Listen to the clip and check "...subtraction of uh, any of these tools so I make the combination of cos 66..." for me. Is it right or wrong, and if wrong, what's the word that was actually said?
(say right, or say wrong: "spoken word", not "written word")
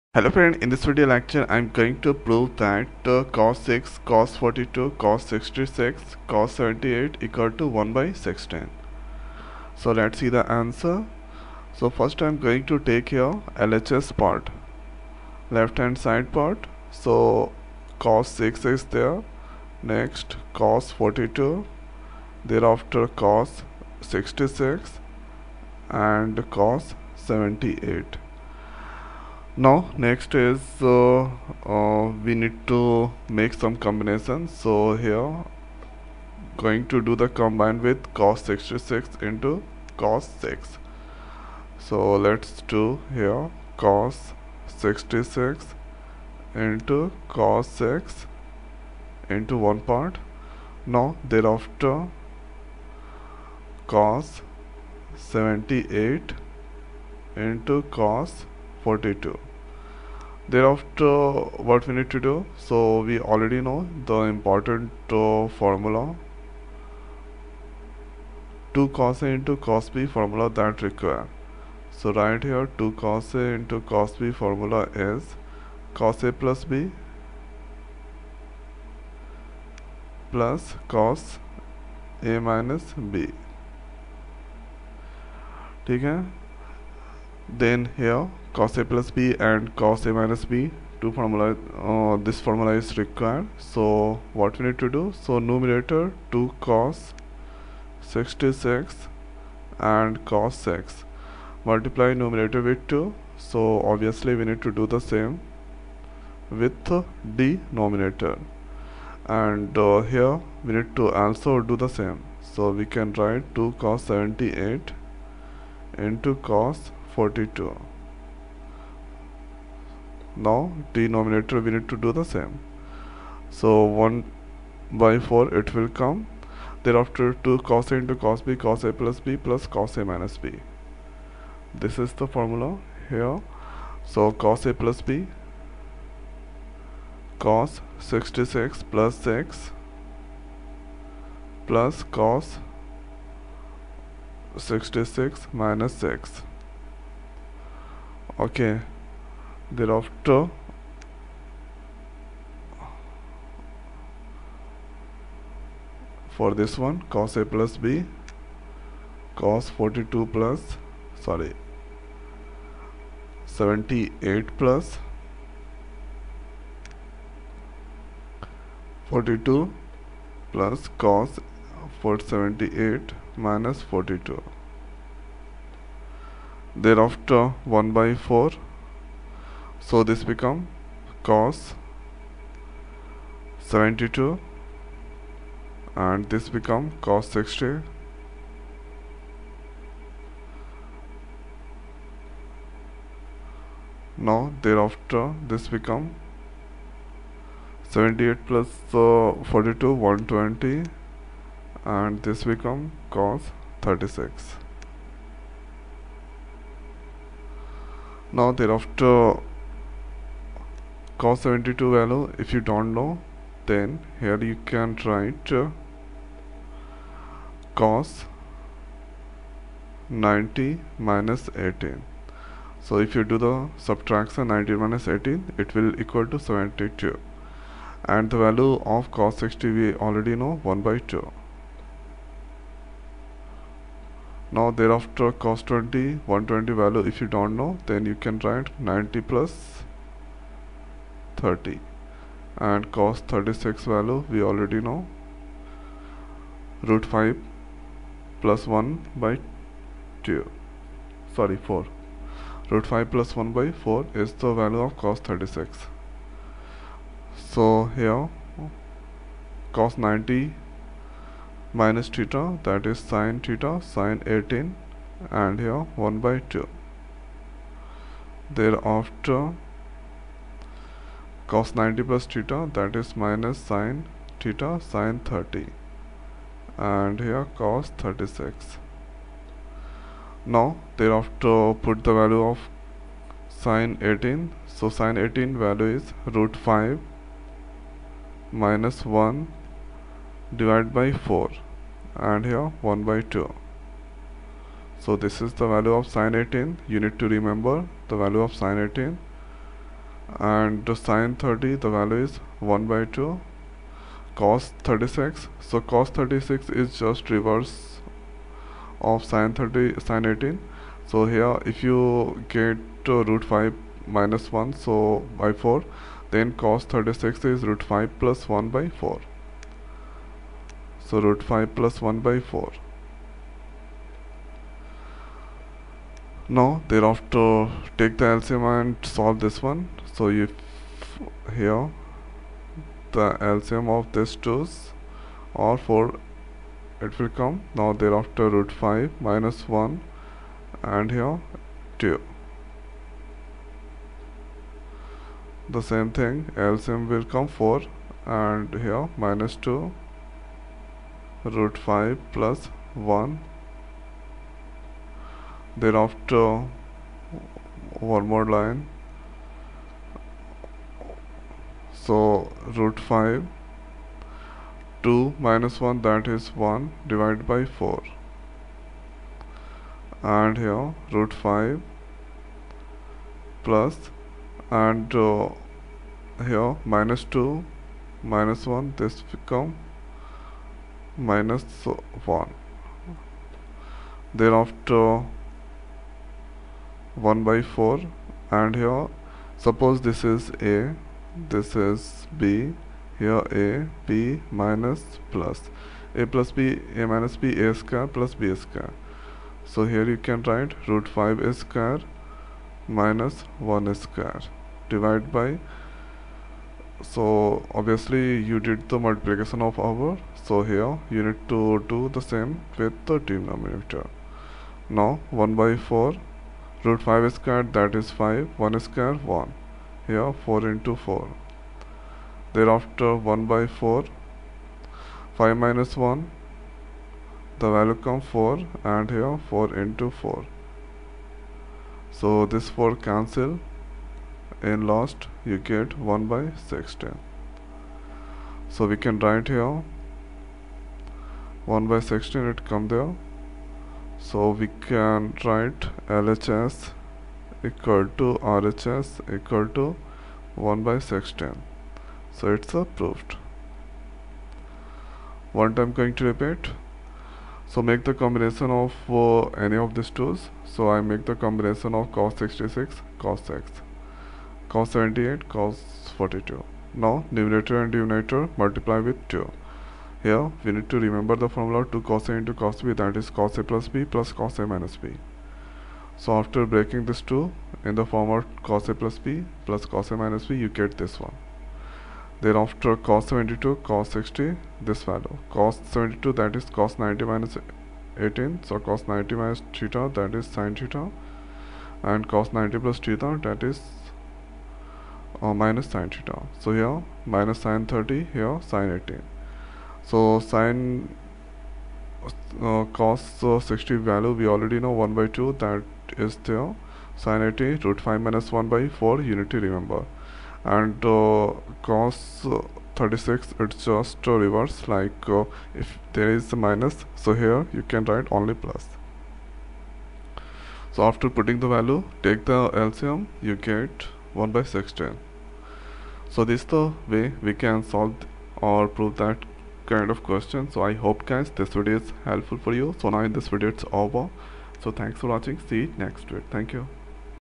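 wrong: "combination", not "subtraction".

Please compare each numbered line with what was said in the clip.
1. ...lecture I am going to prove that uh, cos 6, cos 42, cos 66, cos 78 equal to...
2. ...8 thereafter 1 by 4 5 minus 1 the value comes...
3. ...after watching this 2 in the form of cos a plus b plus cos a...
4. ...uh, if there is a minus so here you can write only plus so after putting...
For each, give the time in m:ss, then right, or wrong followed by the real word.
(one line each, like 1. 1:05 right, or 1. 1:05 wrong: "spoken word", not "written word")
1. 0:01 right
2. 7:00 wrong: "4", not "8"
3. 7:56 wrong: "breaking", not "watching"
4. 8:35 right.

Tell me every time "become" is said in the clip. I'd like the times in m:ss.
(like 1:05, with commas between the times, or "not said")
3:00, 3:06, 3:15, 3:22, 6:19.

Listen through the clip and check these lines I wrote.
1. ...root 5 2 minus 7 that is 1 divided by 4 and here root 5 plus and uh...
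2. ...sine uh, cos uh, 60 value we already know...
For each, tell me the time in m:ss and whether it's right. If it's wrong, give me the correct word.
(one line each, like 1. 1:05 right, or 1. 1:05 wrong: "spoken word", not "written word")
1. 6:02 wrong: "1", not "7"
2. 8:20 right.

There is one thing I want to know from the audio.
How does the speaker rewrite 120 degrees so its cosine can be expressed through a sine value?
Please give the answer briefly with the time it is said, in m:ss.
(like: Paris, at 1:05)
90 plus 30, at 3:58.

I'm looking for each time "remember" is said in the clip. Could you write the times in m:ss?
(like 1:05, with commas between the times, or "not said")
4:57, 7:51, 8:29.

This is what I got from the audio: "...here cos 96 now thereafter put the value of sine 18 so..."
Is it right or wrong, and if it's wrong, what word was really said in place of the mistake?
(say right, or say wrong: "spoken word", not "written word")
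wrong: "36", not "96".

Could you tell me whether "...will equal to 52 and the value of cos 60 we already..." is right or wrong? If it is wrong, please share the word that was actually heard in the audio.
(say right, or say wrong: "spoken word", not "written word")
wrong: "72", not "52".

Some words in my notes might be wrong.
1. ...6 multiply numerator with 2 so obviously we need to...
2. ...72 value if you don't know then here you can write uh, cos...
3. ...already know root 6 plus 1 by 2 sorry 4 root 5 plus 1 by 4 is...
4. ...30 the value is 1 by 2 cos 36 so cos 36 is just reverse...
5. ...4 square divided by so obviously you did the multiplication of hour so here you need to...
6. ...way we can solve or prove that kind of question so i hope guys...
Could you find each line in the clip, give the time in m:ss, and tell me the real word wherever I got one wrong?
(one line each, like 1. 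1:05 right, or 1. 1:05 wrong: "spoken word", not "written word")
1. 1:40 right
2. 3:31 right
3. 4:04 wrong: "5", not "6"
4. 5:01 right
5. 6:43 wrong: "1", not "4"
6. 8:47 right.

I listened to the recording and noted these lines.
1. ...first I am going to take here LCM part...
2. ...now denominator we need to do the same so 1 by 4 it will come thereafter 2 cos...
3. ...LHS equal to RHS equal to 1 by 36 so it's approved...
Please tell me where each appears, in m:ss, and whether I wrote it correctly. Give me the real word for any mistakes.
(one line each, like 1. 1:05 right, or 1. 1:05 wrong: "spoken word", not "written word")
1. 0:11 wrong: "LHS", not "LCM"
2. 2:00 right
3. 7:26 wrong: "16", not "36".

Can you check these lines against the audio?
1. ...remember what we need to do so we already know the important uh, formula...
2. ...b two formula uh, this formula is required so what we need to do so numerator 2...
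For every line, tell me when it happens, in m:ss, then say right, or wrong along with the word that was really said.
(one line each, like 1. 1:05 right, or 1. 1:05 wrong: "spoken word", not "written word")
1. 1:00 wrong: "thereafter", not "remember"
2. 1:30 right.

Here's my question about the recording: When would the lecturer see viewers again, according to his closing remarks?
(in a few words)
next week.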